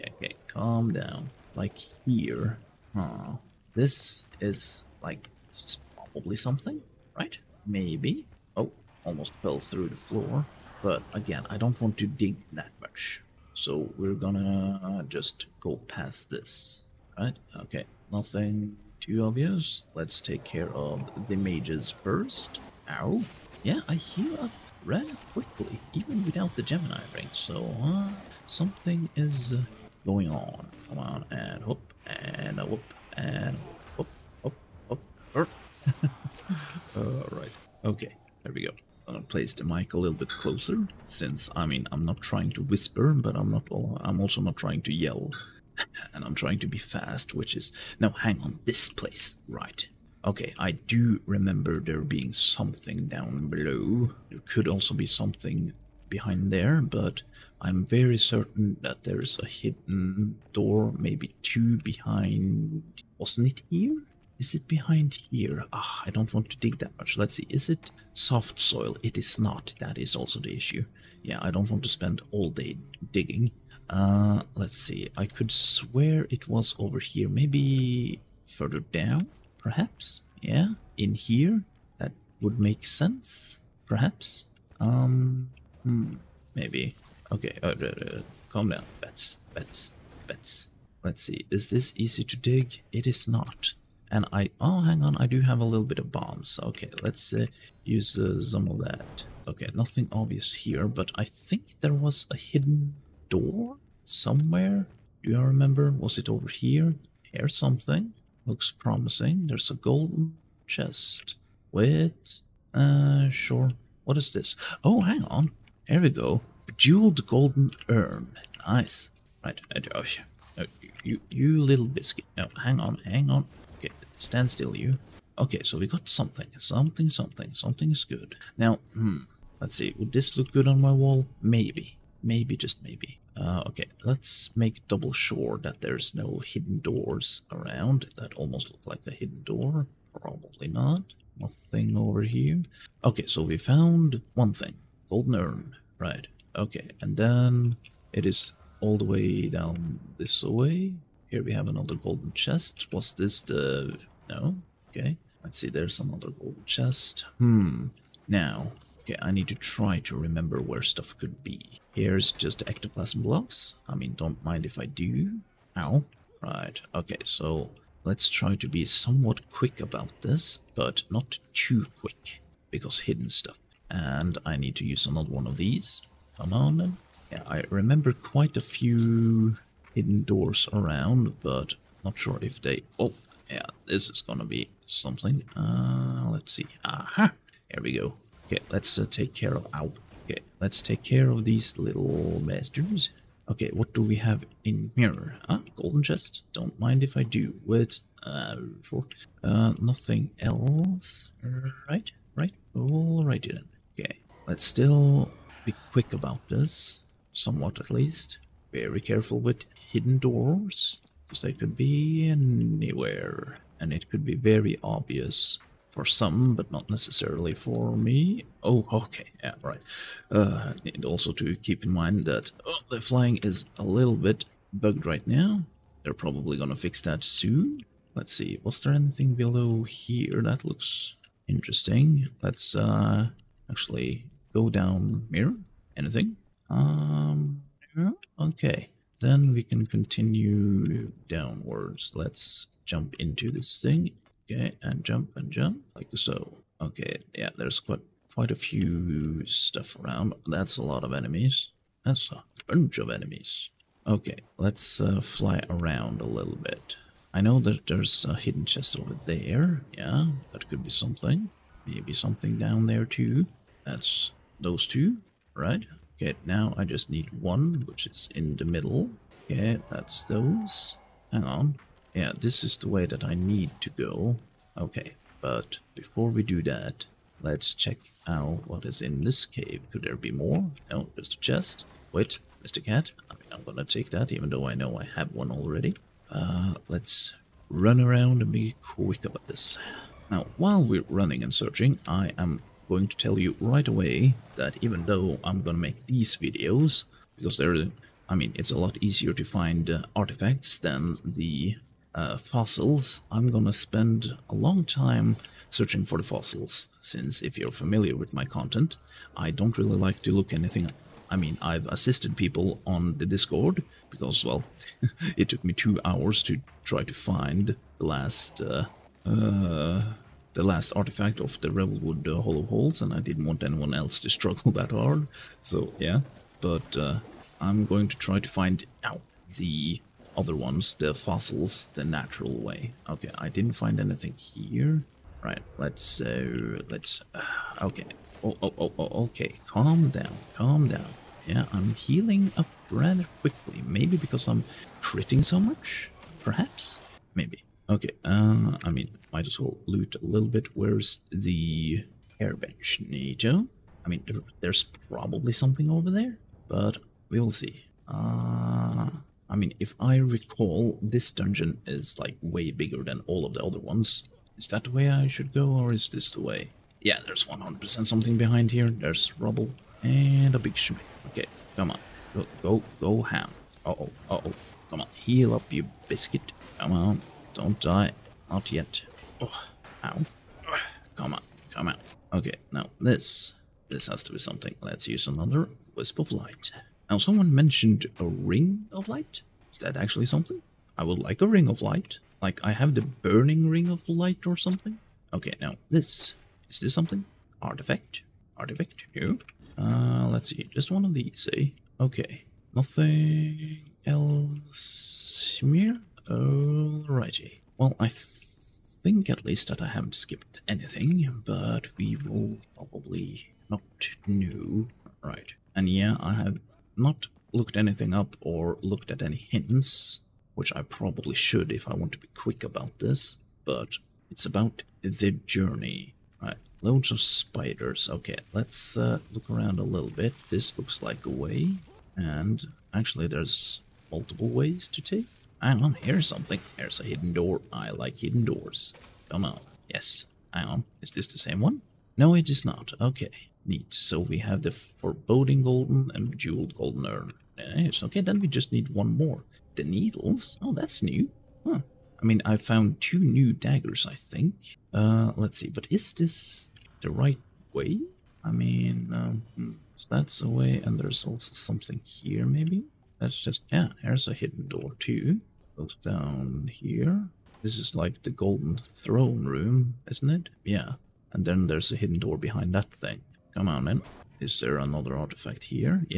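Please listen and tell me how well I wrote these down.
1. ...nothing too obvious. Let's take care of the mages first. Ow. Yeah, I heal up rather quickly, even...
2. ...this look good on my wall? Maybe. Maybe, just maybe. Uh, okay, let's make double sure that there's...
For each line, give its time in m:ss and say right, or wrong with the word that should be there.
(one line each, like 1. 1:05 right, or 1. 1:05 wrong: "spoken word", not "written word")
1. 0:18 right
2. 2:10 right.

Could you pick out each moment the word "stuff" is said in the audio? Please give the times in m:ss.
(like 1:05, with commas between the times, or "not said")
2:40, 2:53, 4:09.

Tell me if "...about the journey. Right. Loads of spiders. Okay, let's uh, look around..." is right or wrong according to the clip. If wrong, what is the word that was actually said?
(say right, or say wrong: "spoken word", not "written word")
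right.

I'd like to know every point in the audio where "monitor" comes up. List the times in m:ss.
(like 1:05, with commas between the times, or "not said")
not said.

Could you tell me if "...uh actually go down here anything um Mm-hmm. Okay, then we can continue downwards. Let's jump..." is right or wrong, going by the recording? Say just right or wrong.
right.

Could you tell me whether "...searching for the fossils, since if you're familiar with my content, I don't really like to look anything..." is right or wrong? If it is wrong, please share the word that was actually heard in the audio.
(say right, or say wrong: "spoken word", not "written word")
right.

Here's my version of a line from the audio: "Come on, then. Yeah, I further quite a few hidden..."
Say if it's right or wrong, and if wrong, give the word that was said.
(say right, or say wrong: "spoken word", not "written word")
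wrong: "remember", not "further".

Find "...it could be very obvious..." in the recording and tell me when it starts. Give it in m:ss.
3:33.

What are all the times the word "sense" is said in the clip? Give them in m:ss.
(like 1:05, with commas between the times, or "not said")
1:22.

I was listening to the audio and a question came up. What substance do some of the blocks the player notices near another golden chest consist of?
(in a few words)
Ectoplasm.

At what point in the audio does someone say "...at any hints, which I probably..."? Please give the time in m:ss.
6:59.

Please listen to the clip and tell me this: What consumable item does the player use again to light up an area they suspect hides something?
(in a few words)
Wisp of Light.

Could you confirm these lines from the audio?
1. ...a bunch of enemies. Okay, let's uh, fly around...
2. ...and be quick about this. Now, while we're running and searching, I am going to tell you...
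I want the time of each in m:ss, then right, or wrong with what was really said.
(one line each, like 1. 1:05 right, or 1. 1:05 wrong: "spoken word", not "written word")
1. 4:12 right
2. 4:48 right.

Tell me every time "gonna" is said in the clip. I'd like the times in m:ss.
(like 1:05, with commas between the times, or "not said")
0:14, 0:39, 3:04, 3:46, 4:43, 4:55, 5:03.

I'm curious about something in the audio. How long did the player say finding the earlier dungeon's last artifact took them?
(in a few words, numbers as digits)
2 hours.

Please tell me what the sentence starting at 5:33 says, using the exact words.
Okay, I didn't find anything here.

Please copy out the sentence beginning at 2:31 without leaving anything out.
Here we have another golden chest.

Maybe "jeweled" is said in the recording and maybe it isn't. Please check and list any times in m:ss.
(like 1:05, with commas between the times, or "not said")
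1:56, 7:26.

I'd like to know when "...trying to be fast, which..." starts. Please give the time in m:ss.
0:46.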